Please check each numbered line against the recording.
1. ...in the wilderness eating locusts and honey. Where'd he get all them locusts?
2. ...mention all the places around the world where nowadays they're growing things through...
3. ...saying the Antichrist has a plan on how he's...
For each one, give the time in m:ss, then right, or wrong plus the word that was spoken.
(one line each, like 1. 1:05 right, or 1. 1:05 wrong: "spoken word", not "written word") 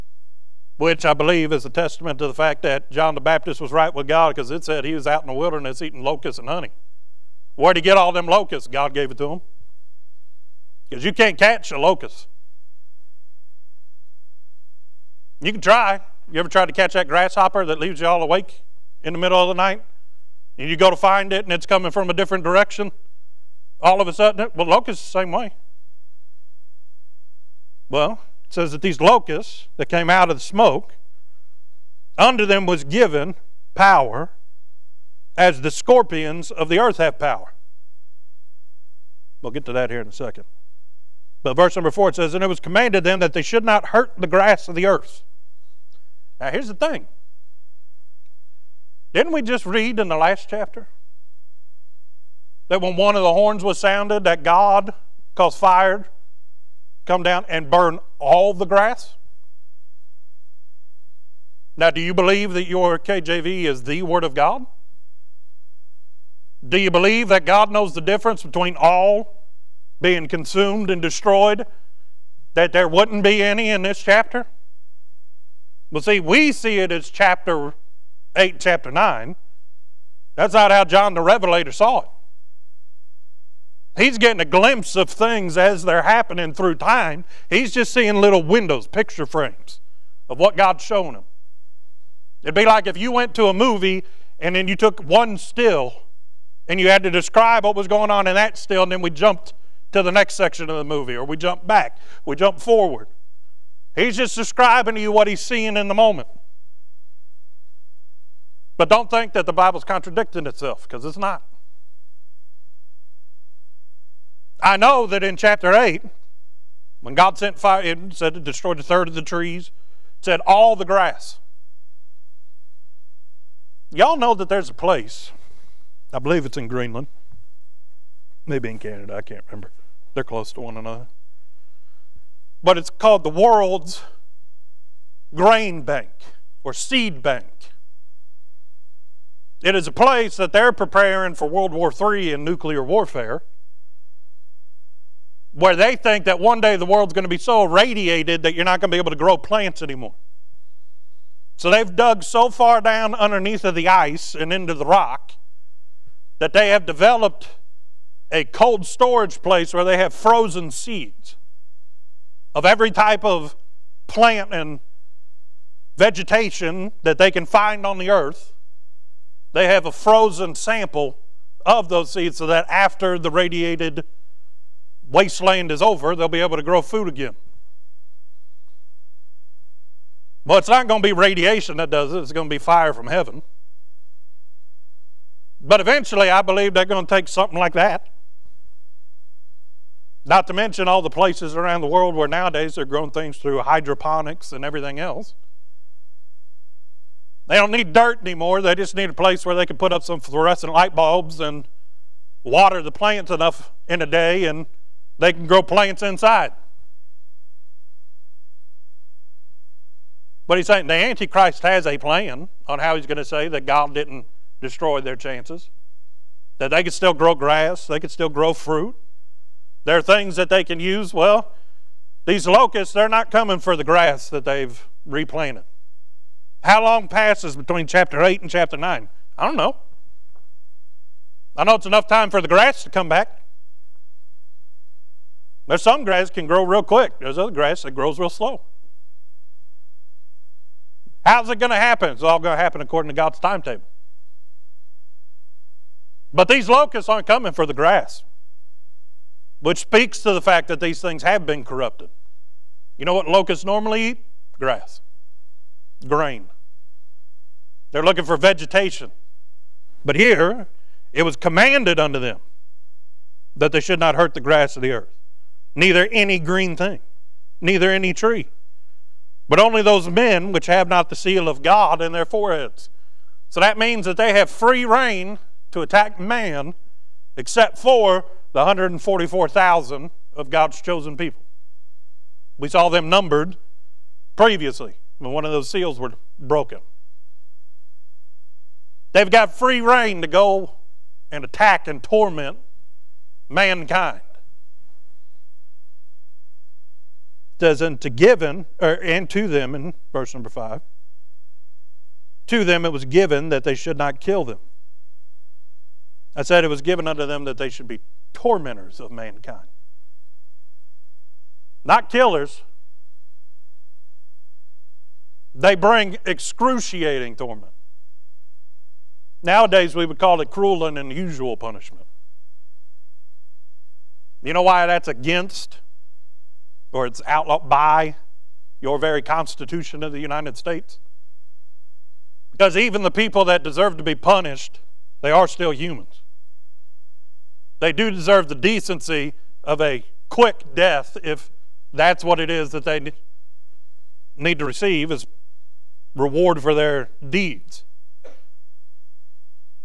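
1. 0:05 right
2. 3:10 right
3. 3:30 right.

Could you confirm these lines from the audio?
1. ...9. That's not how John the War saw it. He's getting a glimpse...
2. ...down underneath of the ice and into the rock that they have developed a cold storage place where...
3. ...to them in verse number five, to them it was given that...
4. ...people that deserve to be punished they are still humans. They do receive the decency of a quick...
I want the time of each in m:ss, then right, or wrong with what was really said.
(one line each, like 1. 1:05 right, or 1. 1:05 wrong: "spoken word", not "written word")
1. 1:18 wrong: "Revelator", not "War"
2. 2:32 right
3. 4:59 right
4. 5:33 wrong: "deserve", not "receive".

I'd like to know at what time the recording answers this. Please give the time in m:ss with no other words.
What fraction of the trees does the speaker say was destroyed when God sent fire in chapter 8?
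1:58.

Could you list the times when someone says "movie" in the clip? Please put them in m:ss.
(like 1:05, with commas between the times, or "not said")
1:33, 1:40.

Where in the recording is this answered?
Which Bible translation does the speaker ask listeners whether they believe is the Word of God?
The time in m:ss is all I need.
1:02.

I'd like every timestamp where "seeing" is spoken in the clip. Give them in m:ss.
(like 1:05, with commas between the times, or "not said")
1:27, 1:45.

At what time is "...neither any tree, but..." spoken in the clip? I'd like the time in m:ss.
4:27.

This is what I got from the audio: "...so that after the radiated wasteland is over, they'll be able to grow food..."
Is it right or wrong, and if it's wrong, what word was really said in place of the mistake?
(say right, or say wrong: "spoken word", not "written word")
right.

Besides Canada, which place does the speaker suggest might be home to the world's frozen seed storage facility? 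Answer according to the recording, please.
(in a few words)
Greenland.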